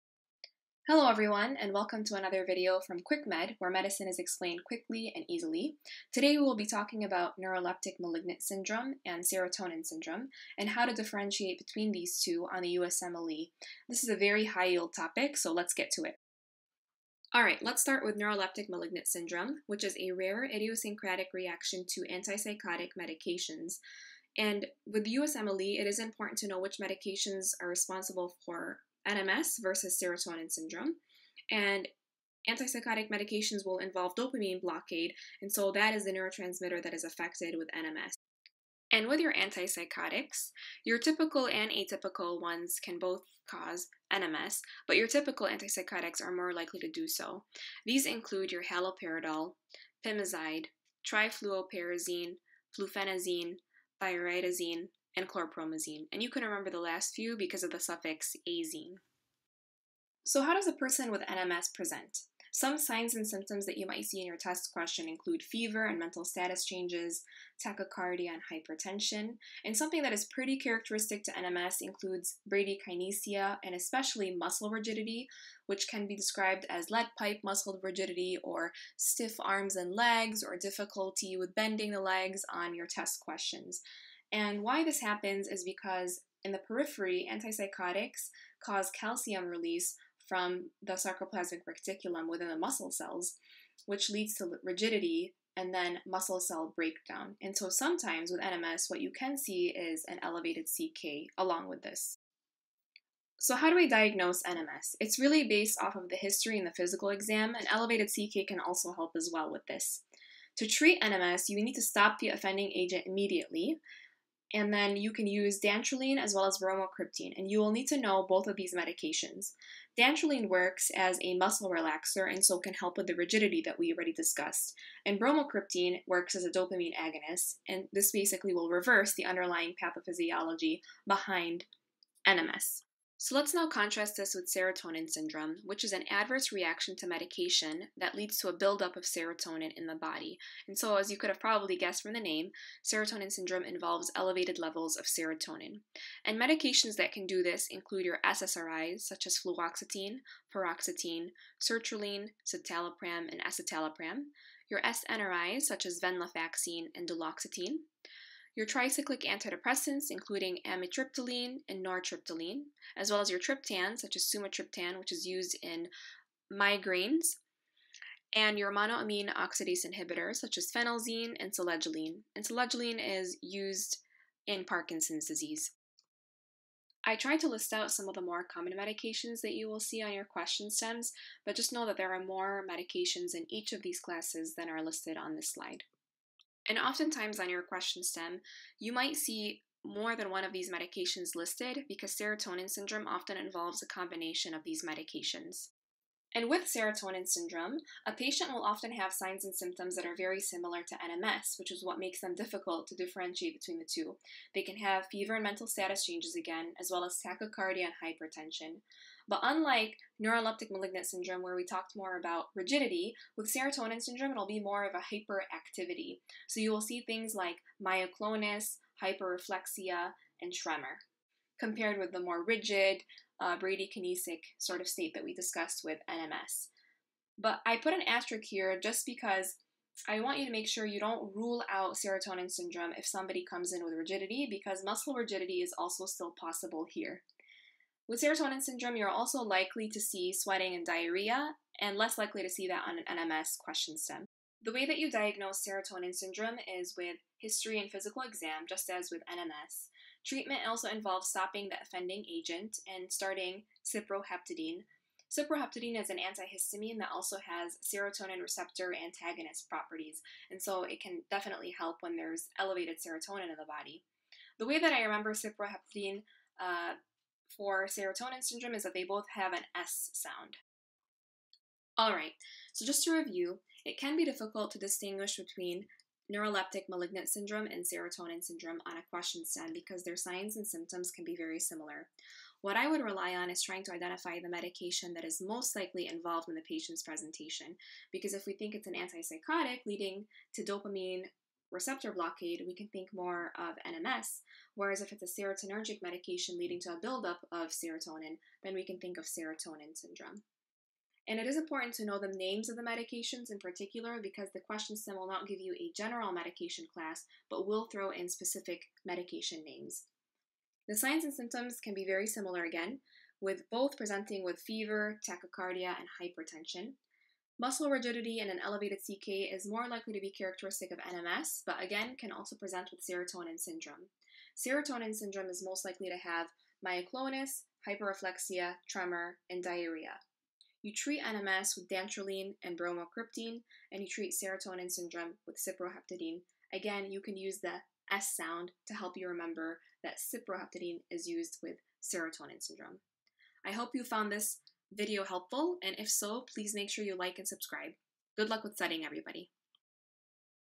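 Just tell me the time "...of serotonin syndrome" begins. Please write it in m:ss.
4:59.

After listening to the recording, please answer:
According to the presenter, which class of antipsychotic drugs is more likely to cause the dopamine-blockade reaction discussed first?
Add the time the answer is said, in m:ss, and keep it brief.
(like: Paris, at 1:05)
Typical antipsychotics, at 0:45.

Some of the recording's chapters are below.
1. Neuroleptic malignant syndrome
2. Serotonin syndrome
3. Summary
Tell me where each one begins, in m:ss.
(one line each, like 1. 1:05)
1. 0:16
2. 2:14
3. 4:31.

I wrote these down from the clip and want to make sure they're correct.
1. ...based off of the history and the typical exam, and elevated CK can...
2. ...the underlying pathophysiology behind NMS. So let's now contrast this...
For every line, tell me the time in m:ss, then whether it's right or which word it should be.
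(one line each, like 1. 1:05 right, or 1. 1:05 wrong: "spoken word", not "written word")
1. 1:45 wrong: "physical", not "typical"
2. 2:09 right.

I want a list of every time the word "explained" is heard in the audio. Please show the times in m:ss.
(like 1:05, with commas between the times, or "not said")
0:04.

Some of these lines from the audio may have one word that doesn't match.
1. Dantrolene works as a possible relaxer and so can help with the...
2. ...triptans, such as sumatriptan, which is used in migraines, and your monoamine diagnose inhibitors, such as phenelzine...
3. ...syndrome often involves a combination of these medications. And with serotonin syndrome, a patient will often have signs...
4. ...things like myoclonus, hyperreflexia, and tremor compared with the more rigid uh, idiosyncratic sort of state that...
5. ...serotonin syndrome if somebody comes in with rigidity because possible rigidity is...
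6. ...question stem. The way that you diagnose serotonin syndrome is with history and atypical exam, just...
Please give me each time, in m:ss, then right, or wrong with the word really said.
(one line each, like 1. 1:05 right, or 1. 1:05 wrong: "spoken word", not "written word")
1. 1:59 wrong: "muscle", not "possible"
2. 2:43 wrong: "oxidase", not "diagnose"
3. 3:12 right
4. 3:37 wrong: "bradykinesic", not "idiosyncratic"
5. 3:51 wrong: "muscle", not "possible"
6. 4:03 wrong: "physical", not "atypical".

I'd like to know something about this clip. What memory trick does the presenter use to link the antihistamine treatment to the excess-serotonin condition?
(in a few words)
Both have an S sound.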